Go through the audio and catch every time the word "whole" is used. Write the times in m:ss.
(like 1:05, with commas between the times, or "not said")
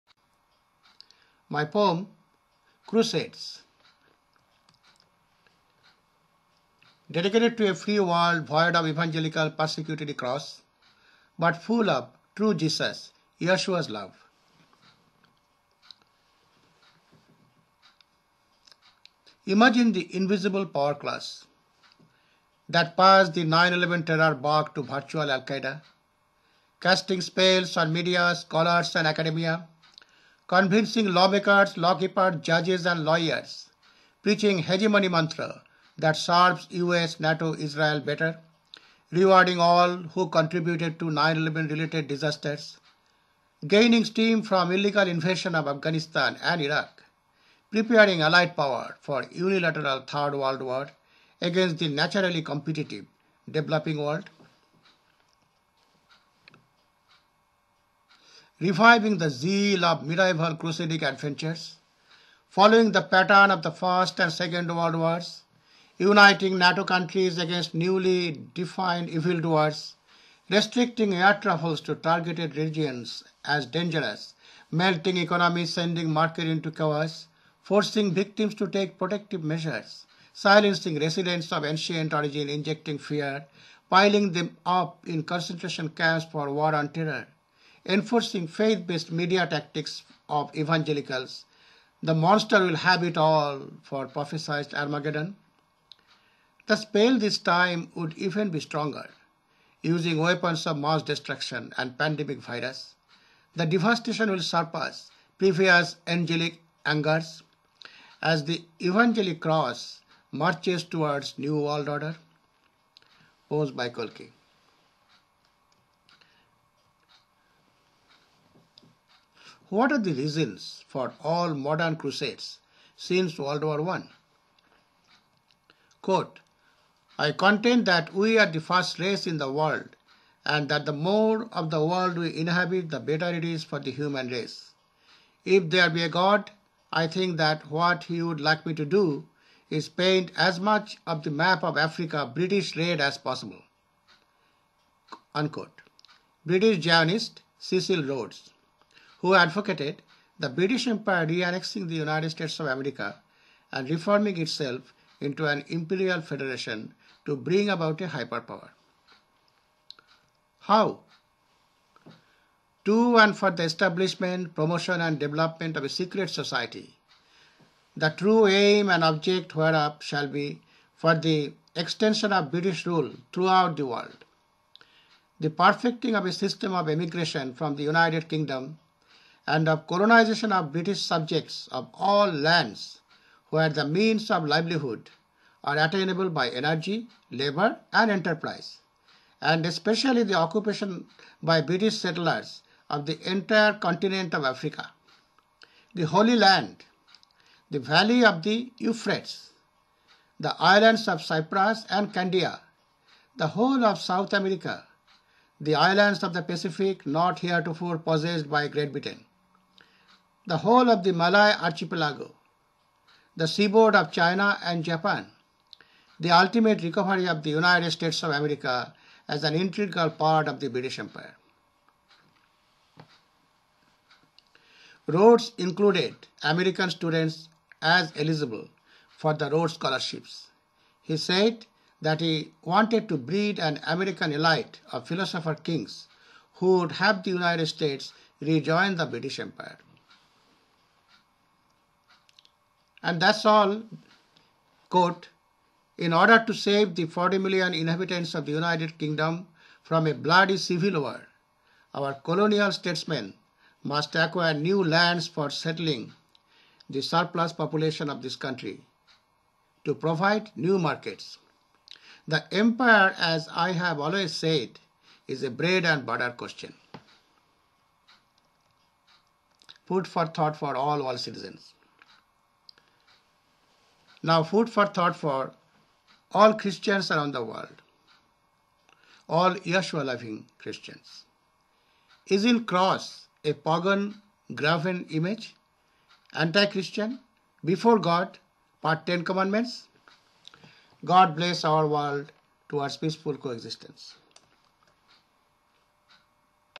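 3:23, 3:30.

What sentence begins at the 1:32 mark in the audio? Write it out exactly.
The monster will have it all for prophesied Armageddon.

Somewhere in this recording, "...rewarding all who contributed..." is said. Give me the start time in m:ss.
0:39.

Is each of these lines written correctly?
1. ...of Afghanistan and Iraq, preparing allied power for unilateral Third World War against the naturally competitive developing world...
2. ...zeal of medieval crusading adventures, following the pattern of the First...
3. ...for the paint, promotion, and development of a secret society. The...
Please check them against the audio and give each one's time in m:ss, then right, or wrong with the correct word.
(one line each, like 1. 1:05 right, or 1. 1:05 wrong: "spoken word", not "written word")
1. 0:45 right
2. 0:59 right
3. 2:43 wrong: "establishment", not "paint".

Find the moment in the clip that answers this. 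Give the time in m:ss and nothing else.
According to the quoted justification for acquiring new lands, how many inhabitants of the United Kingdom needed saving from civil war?
4:07.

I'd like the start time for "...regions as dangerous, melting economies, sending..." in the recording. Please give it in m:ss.
1:12.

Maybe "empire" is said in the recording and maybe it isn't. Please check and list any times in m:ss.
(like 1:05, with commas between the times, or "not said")
2:30, 3:40, 3:59, 4:22.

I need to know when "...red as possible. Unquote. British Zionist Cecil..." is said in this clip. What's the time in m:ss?
2:22.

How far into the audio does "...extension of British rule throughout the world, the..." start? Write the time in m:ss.
2:51.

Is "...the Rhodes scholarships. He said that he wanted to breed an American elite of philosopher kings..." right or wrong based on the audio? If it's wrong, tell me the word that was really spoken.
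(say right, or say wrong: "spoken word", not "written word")
right.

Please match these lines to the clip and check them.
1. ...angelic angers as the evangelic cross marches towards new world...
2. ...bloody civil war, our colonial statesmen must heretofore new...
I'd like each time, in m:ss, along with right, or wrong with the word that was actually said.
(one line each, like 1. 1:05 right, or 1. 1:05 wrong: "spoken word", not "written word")
1. 1:46 right
2. 4:10 wrong: "acquire", not "heretofore".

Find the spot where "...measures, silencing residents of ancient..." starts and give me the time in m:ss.
1:19.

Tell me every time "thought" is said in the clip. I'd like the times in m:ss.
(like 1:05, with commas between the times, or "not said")
4:30, 4:34.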